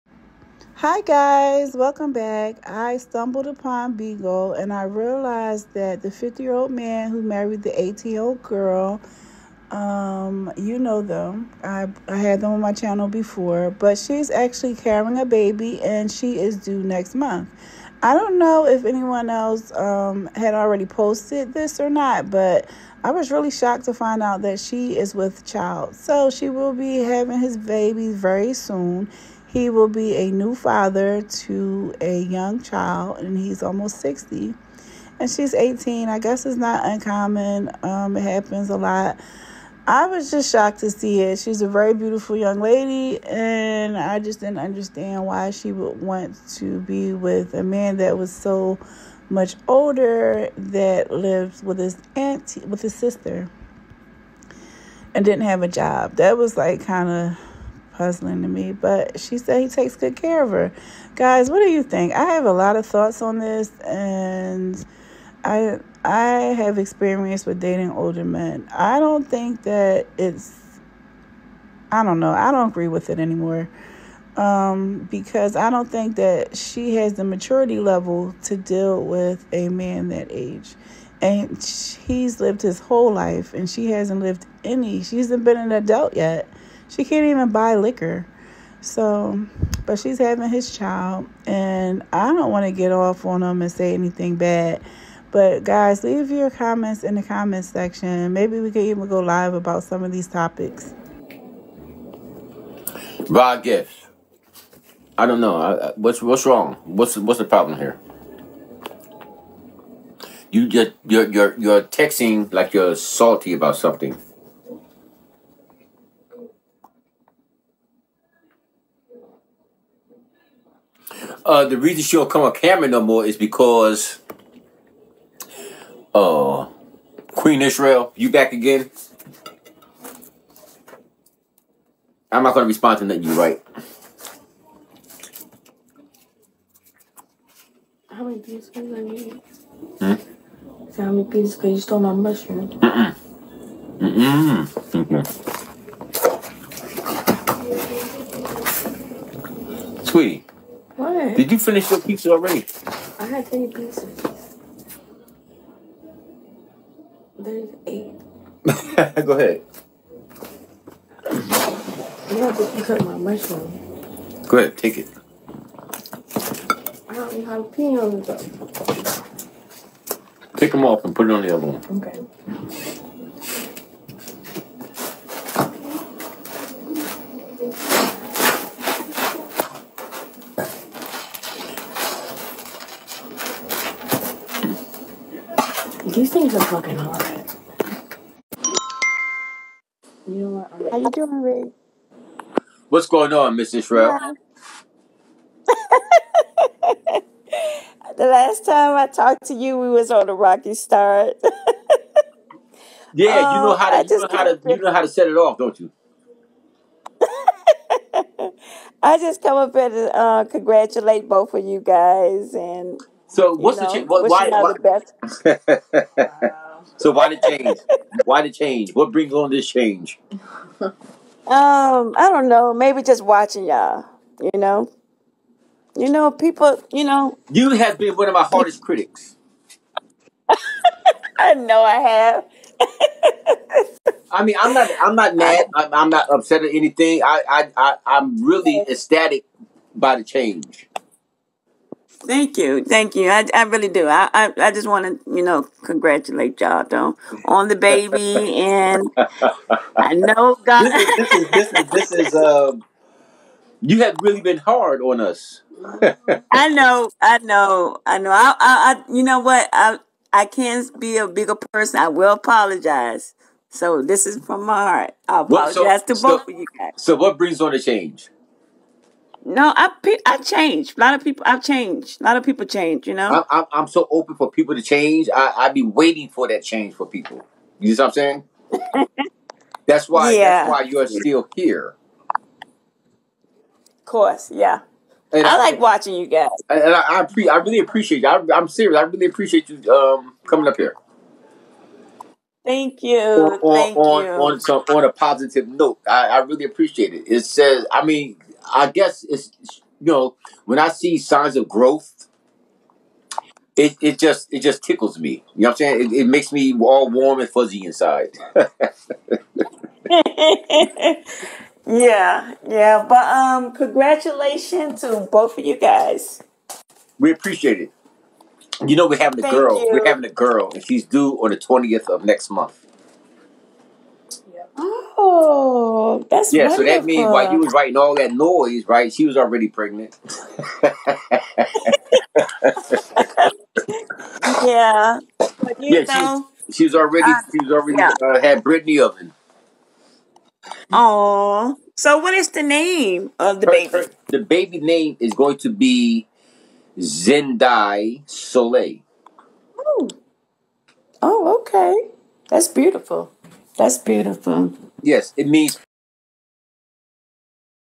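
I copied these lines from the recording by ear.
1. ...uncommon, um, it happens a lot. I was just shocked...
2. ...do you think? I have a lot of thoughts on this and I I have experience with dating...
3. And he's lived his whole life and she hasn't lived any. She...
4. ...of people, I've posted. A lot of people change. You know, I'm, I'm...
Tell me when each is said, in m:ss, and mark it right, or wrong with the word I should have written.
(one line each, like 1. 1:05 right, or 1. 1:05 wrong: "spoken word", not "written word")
1. 0:36 right
2. 1:01 right
3. 1:21 right
4. 4:31 wrong: "changed", not "posted".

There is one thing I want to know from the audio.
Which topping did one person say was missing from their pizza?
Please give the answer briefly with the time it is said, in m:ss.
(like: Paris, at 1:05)
jalapenos, at 2:47.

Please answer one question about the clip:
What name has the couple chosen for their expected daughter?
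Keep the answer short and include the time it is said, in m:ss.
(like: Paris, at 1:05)
Zendai Soleil, at 5:46.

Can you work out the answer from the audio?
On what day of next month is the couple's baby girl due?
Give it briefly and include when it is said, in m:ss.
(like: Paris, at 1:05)
the 20th, at 5:21.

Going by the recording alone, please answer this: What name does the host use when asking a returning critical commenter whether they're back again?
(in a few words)
Queen Israel.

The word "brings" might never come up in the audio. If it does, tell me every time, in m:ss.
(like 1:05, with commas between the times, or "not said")
3:39, 4:27.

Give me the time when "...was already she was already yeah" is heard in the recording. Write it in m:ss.
5:36.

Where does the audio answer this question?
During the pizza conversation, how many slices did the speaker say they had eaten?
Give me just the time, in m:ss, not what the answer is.
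2:33.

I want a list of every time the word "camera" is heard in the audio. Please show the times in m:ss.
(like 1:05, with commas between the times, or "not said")
2:02.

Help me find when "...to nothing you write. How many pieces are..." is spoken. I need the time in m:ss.
2:12.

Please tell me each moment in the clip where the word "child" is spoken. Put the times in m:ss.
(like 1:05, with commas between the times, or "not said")
0:25, 0:32, 1:30.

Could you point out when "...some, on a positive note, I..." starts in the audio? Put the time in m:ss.
4:54.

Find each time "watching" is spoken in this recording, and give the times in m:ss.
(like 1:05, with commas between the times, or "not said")
3:43, 4:45.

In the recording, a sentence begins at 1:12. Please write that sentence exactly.
I don't agree with it anymore.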